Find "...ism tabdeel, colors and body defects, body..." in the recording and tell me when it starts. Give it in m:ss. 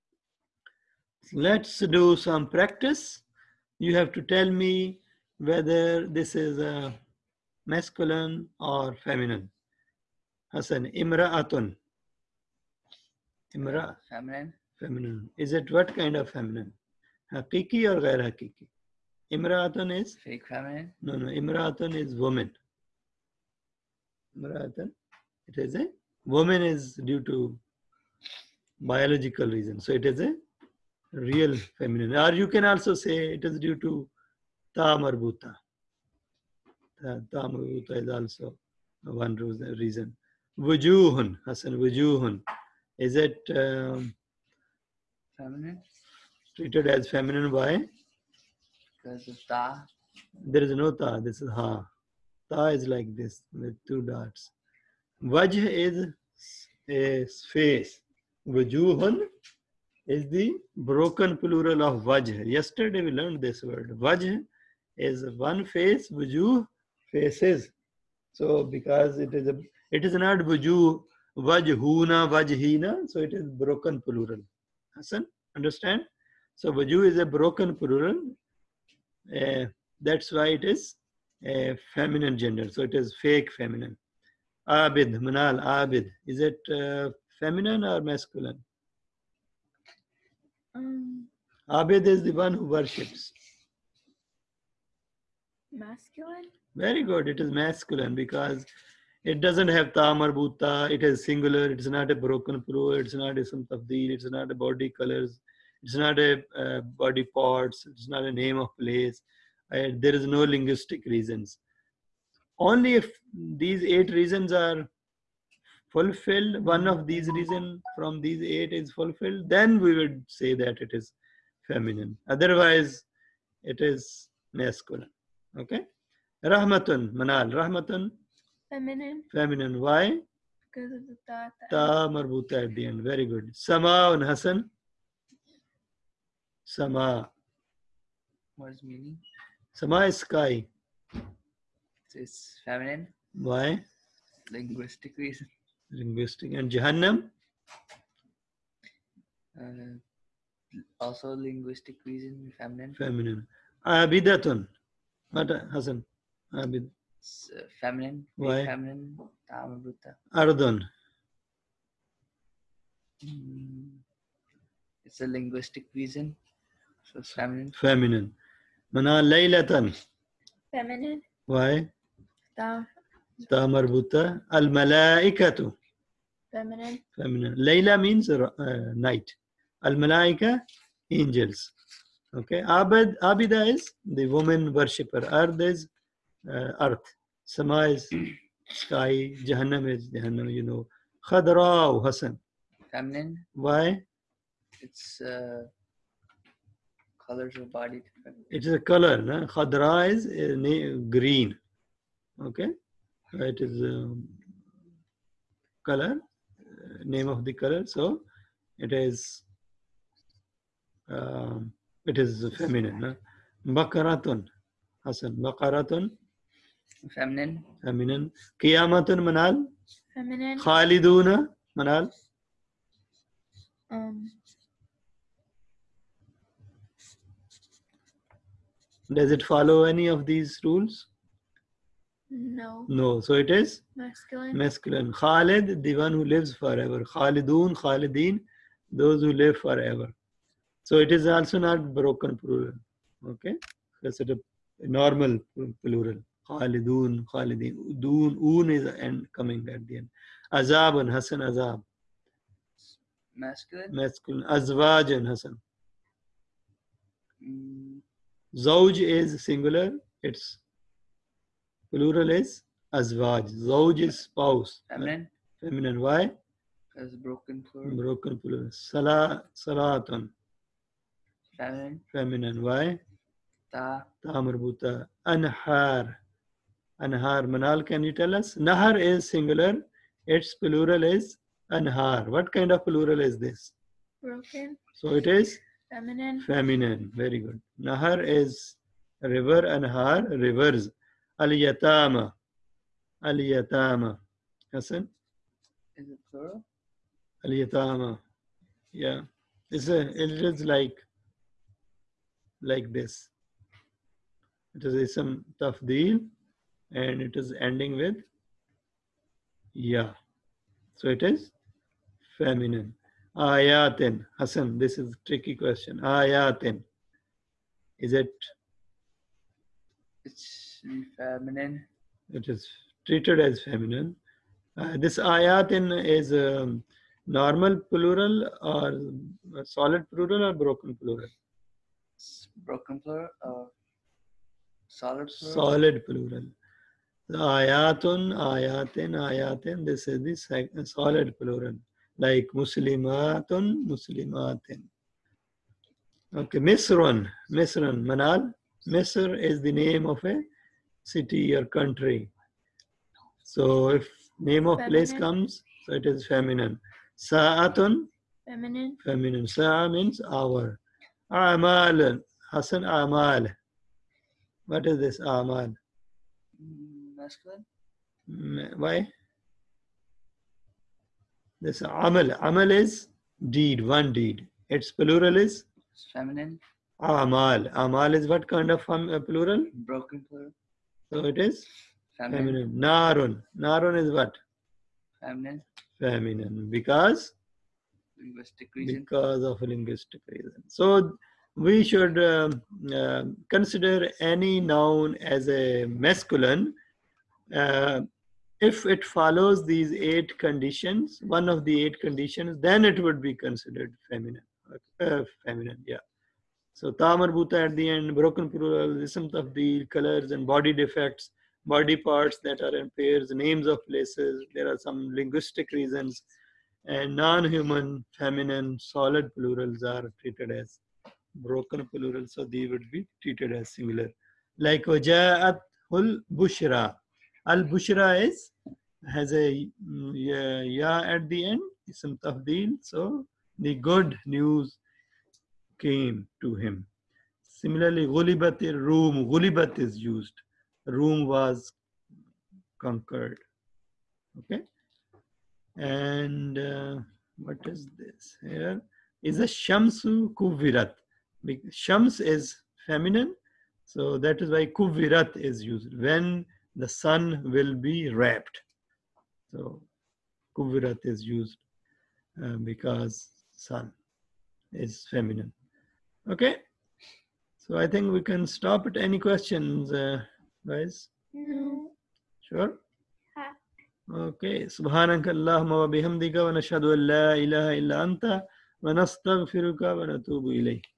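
6:49.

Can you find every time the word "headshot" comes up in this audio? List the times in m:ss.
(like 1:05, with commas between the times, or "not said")
not said.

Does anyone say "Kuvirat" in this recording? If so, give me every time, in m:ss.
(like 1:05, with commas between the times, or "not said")
7:30, 7:34, 7:40.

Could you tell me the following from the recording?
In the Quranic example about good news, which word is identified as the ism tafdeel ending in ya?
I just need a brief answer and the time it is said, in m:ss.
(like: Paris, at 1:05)
Al bushra, at 7:07.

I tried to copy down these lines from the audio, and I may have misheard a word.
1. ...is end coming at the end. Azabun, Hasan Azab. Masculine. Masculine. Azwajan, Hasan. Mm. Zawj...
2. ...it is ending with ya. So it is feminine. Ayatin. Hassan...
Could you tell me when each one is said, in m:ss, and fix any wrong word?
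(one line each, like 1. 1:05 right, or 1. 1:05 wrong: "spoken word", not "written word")
1. 4:08 right
2. 5:07 right.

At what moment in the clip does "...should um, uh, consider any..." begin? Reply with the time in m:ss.
6:31.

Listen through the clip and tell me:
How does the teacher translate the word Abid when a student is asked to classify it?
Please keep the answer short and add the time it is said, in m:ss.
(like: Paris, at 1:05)
the one who worships, at 1:32.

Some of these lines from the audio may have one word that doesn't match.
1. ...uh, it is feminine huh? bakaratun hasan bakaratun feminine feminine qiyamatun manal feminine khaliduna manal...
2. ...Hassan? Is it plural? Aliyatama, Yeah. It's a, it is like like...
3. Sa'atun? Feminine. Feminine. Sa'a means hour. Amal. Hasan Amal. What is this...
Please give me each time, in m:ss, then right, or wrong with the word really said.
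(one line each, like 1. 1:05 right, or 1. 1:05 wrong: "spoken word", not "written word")
1. 3:31 right
2. 4:54 right
3. 5:57 right.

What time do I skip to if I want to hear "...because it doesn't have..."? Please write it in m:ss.
1:38.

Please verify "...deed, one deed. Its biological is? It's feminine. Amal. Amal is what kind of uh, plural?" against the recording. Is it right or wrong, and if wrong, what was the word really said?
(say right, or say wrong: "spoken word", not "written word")
wrong: "plural", not "biological".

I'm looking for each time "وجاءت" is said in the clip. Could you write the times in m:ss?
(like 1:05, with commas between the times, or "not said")
7:04.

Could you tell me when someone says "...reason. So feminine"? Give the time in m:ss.
2:45.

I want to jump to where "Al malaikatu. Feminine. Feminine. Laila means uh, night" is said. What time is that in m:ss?
2:54.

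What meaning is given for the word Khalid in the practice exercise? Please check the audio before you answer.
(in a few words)
the one who lives forever.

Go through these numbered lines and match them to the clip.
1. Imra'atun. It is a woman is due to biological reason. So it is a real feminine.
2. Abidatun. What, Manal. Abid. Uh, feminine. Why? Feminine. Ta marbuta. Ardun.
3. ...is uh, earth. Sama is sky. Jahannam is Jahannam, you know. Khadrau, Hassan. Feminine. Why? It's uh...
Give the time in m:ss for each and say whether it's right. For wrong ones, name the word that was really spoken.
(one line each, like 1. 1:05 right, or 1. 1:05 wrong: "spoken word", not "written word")
1. 0:24 right
2. 2:33 wrong: "Hasan", not "Manal"
3. 3:05 right.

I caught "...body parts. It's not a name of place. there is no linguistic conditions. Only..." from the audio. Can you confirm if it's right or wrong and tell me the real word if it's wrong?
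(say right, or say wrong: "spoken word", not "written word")
wrong: "reasons", not "conditions".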